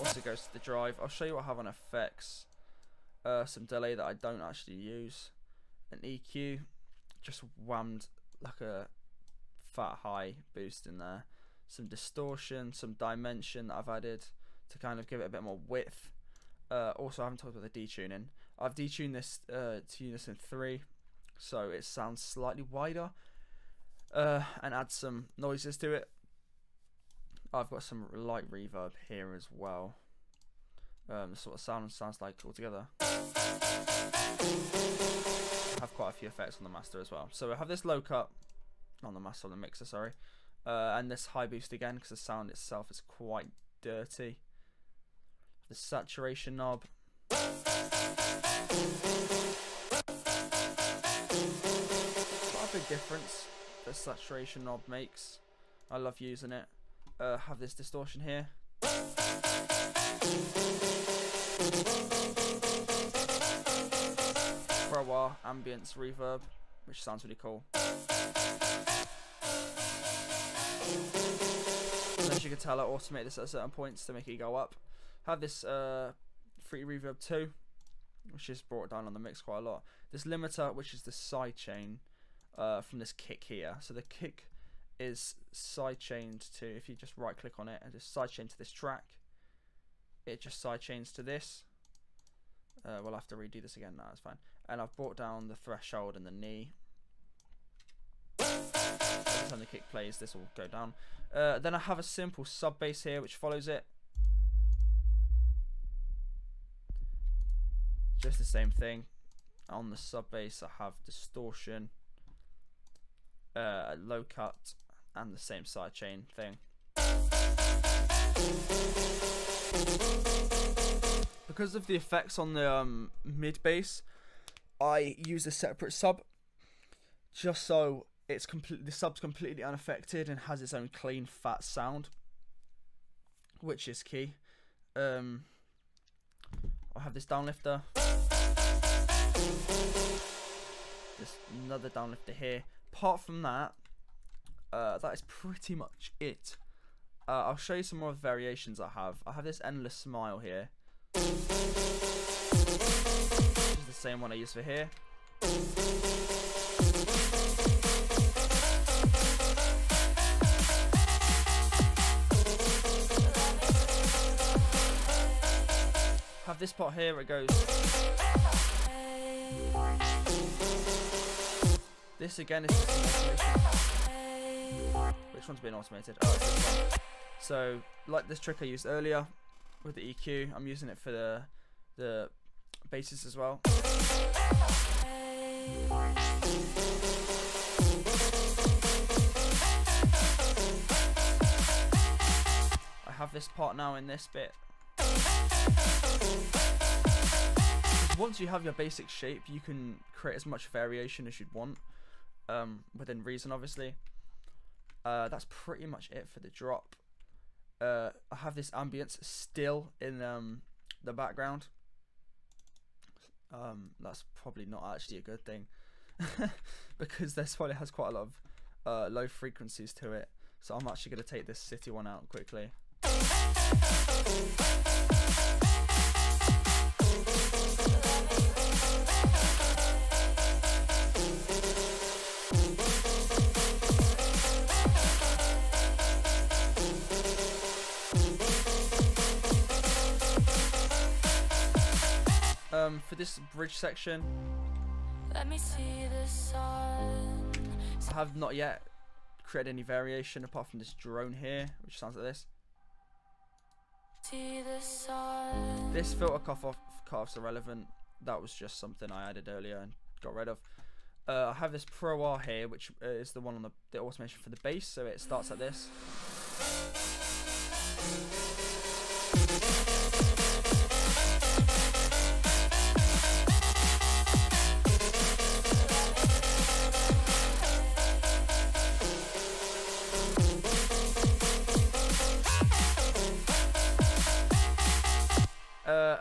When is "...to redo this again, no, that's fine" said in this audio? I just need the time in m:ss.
1:33.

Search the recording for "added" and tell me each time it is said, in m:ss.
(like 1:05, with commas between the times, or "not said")
0:13, 4:19.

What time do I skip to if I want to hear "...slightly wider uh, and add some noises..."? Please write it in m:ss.
0:22.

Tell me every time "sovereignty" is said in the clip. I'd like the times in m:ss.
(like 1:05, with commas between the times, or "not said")
not said.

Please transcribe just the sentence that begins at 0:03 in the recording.
Uh, some delay that I don't actually use.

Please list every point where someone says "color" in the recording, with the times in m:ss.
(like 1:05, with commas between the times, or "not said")
not said.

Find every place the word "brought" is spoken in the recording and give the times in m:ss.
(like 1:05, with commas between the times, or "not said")
1:18, 1:34.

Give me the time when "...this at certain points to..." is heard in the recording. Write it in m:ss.
1:13.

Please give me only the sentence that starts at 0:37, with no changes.
So I have this low cut, on the master, on the mixer, sorry.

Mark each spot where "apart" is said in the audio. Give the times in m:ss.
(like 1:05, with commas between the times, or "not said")
2:22, 4:10.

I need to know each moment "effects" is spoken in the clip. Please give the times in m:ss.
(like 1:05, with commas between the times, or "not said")
0:01, 0:36, 2:01.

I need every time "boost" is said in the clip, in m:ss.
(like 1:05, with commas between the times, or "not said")
0:10, 0:41.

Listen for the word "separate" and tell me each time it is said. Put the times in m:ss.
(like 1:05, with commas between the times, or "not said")
2:05.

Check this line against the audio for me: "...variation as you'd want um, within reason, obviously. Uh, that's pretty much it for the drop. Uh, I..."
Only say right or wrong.
right.